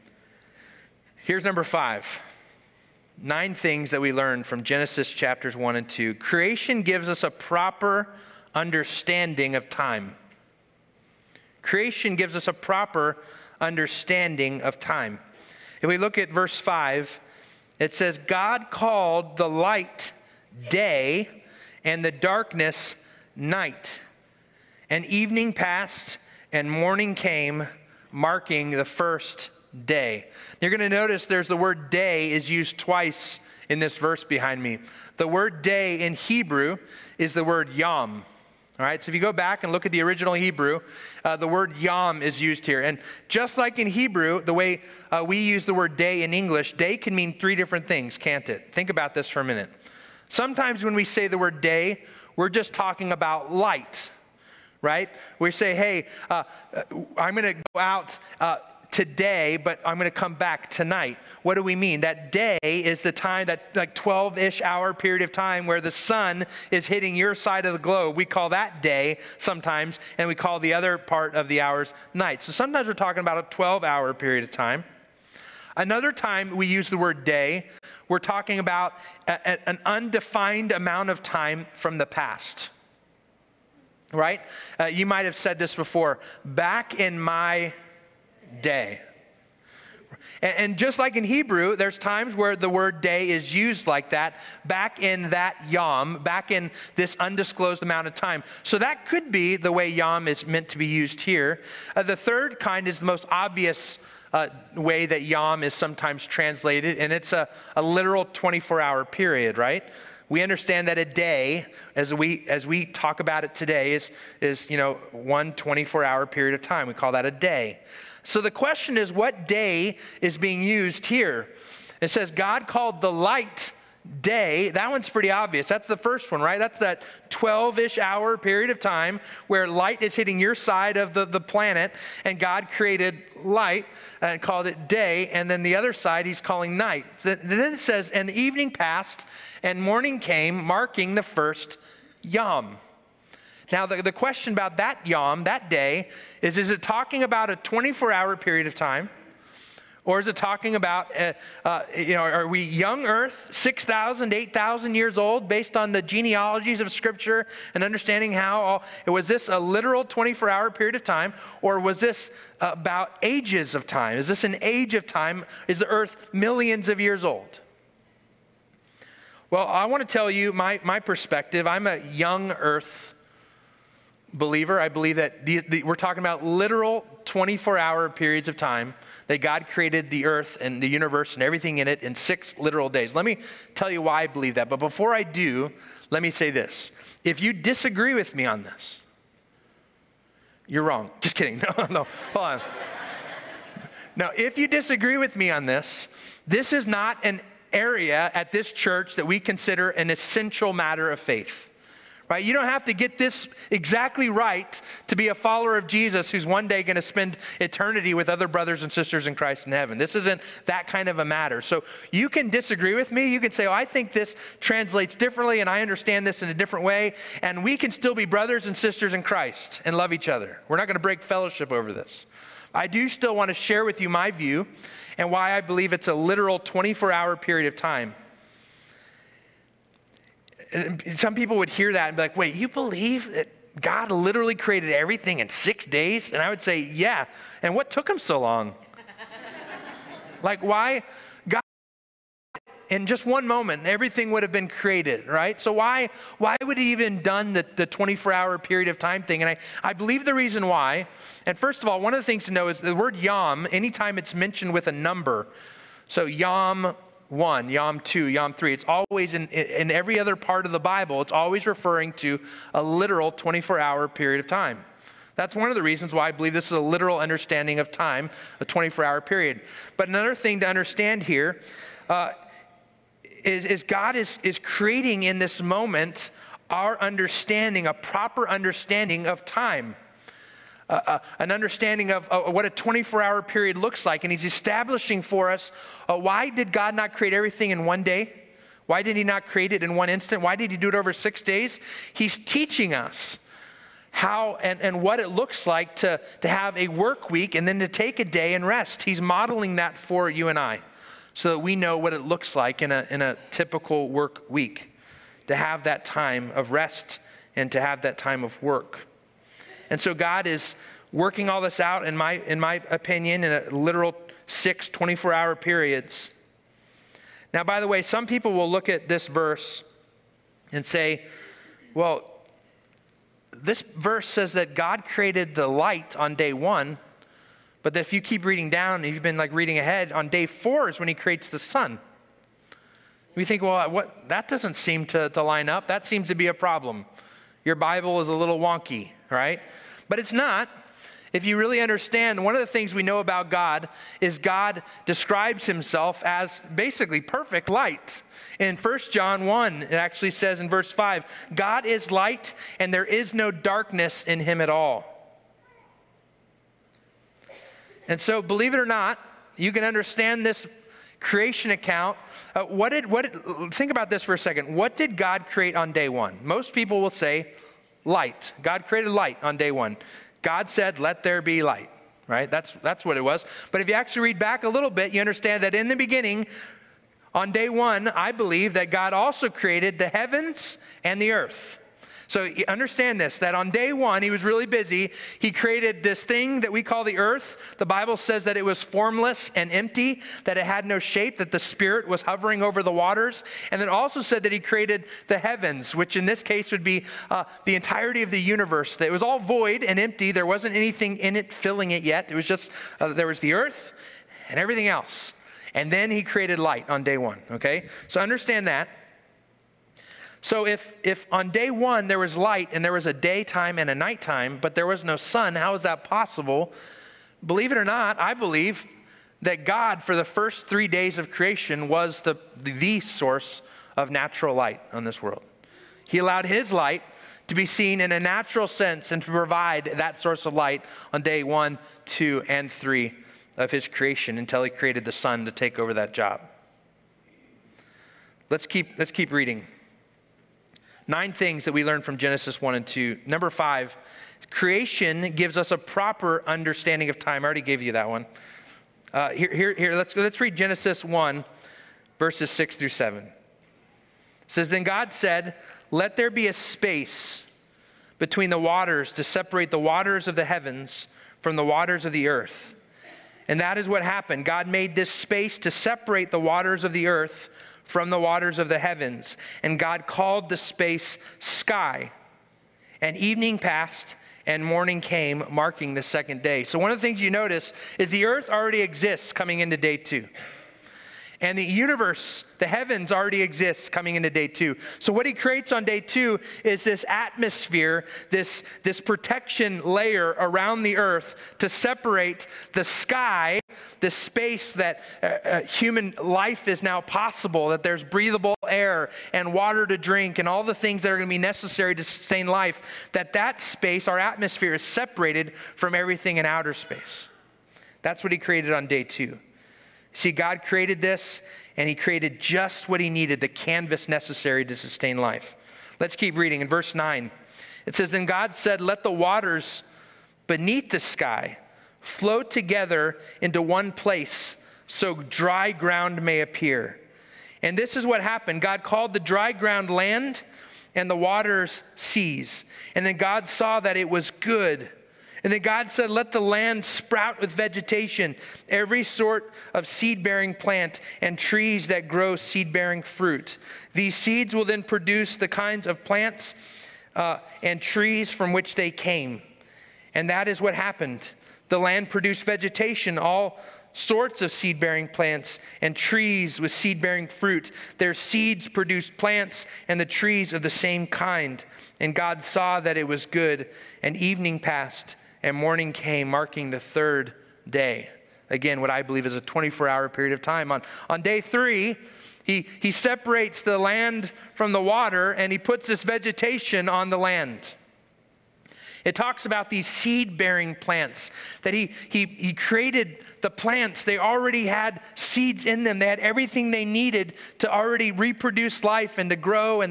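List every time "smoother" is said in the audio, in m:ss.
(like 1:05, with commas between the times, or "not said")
not said.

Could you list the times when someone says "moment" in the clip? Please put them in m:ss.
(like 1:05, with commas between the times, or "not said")
4:03, 4:35.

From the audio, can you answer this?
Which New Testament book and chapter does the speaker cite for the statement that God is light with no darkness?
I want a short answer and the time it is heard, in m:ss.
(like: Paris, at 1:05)
1 John 1, at 5:48.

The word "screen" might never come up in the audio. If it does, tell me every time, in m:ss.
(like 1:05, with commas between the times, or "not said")
not said.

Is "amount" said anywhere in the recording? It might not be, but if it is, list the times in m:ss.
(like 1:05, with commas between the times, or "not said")
1:20, 1:37.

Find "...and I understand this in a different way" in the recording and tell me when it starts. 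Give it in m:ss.
3:35.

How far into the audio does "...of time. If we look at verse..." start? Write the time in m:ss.
0:14.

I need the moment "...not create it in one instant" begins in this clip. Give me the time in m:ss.
4:49.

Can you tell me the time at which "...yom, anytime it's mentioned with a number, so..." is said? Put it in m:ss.
4:13.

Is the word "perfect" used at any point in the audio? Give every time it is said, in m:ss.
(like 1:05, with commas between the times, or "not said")
5:47.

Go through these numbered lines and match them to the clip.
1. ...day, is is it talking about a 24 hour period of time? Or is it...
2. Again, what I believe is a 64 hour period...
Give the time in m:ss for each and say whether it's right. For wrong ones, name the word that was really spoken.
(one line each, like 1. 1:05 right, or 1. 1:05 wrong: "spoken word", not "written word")
1. 2:25 right
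2. 9:28 wrong: "24", not "64".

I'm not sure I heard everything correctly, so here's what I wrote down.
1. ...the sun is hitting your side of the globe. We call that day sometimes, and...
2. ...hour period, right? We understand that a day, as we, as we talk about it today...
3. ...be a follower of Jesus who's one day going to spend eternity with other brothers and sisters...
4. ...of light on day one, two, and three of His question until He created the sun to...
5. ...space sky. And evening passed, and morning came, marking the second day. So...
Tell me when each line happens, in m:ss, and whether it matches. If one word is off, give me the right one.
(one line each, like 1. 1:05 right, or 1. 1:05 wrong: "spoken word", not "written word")
1. 1:05 right
2. 1:48 right
3. 3:25 right
4. 7:10 wrong: "creation", not "question"
5. 7:50 right.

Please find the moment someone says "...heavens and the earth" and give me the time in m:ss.
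6:20.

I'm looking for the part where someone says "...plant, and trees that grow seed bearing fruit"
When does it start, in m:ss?
9:00.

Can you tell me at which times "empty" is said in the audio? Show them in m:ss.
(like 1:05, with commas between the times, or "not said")
6:29, 6:39.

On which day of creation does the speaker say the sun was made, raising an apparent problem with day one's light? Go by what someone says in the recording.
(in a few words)
Day 4.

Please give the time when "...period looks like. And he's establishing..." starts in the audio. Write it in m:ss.
4:43.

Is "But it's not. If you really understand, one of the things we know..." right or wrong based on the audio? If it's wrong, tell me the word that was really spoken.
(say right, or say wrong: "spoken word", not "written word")
right.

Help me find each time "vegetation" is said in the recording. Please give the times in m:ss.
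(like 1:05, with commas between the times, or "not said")
8:57, 9:12, 9:36.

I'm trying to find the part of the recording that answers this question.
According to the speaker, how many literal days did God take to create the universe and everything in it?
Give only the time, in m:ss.
3:02.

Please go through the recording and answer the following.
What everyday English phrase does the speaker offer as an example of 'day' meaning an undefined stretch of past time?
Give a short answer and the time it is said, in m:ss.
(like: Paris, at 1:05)
Back in my day, at 1:26.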